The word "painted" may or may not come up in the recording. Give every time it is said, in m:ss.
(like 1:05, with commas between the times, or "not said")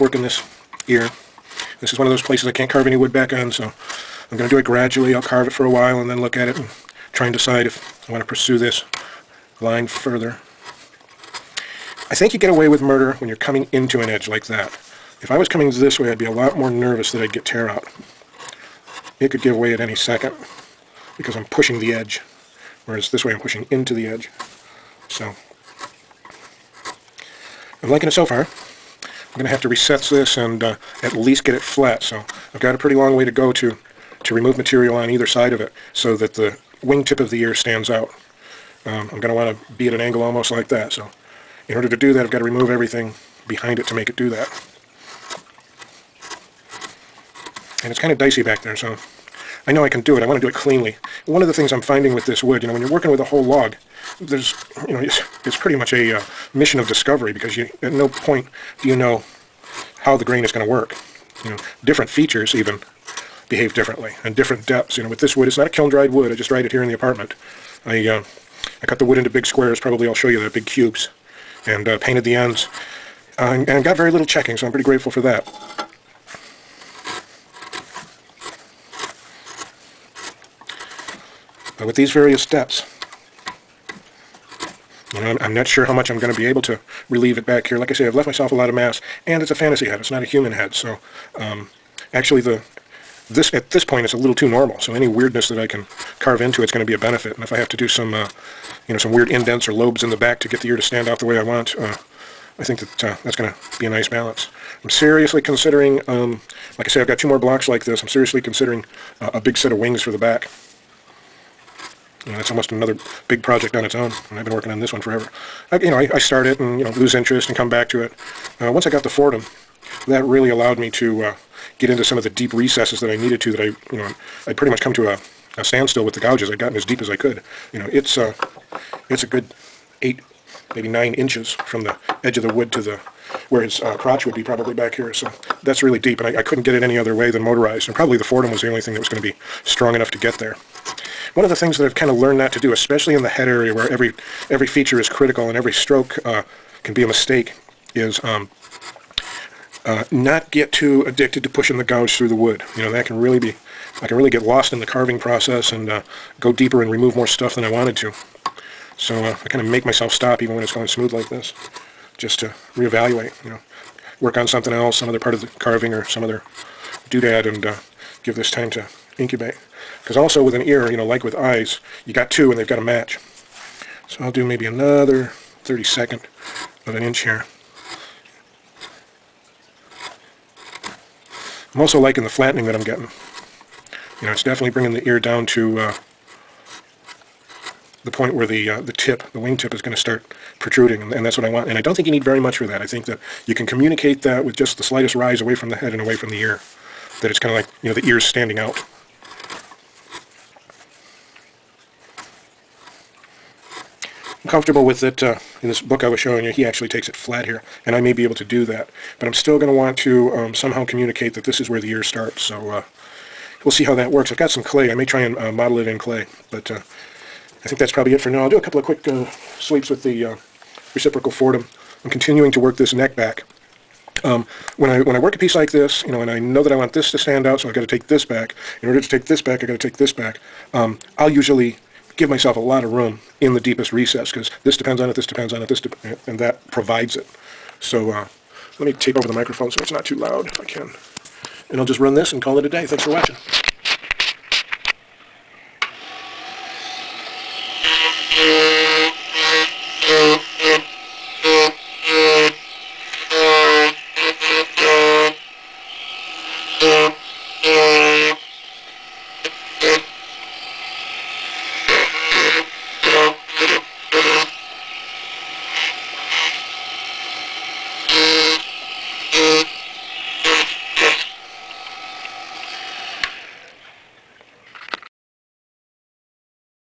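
1:12.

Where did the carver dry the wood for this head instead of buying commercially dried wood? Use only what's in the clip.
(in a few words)
In the apartment.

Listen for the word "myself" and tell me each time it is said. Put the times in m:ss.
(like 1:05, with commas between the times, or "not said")
1:28, 2:39, 3:52.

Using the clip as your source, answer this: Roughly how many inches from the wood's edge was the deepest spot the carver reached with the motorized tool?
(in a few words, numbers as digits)
8 or 9 inches.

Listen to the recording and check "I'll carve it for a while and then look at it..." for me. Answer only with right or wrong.
right.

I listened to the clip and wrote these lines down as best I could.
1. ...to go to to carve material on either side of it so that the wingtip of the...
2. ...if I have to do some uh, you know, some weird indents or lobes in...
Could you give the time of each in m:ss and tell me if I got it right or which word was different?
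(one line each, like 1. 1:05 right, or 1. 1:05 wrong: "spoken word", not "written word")
1. 0:33 wrong: "remove", not "carve"
2. 1:37 right.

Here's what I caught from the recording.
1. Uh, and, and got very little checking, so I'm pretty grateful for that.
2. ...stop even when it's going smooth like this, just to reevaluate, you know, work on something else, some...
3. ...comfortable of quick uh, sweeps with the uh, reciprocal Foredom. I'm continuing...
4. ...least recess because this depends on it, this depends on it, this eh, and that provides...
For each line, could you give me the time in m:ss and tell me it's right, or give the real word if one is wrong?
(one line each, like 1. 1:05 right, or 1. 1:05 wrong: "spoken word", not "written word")
1. 1:13 right
2. 2:40 right
3. 3:38 wrong: "couple", not "comfortable"
4. 3:53 wrong: "deepest", not "least".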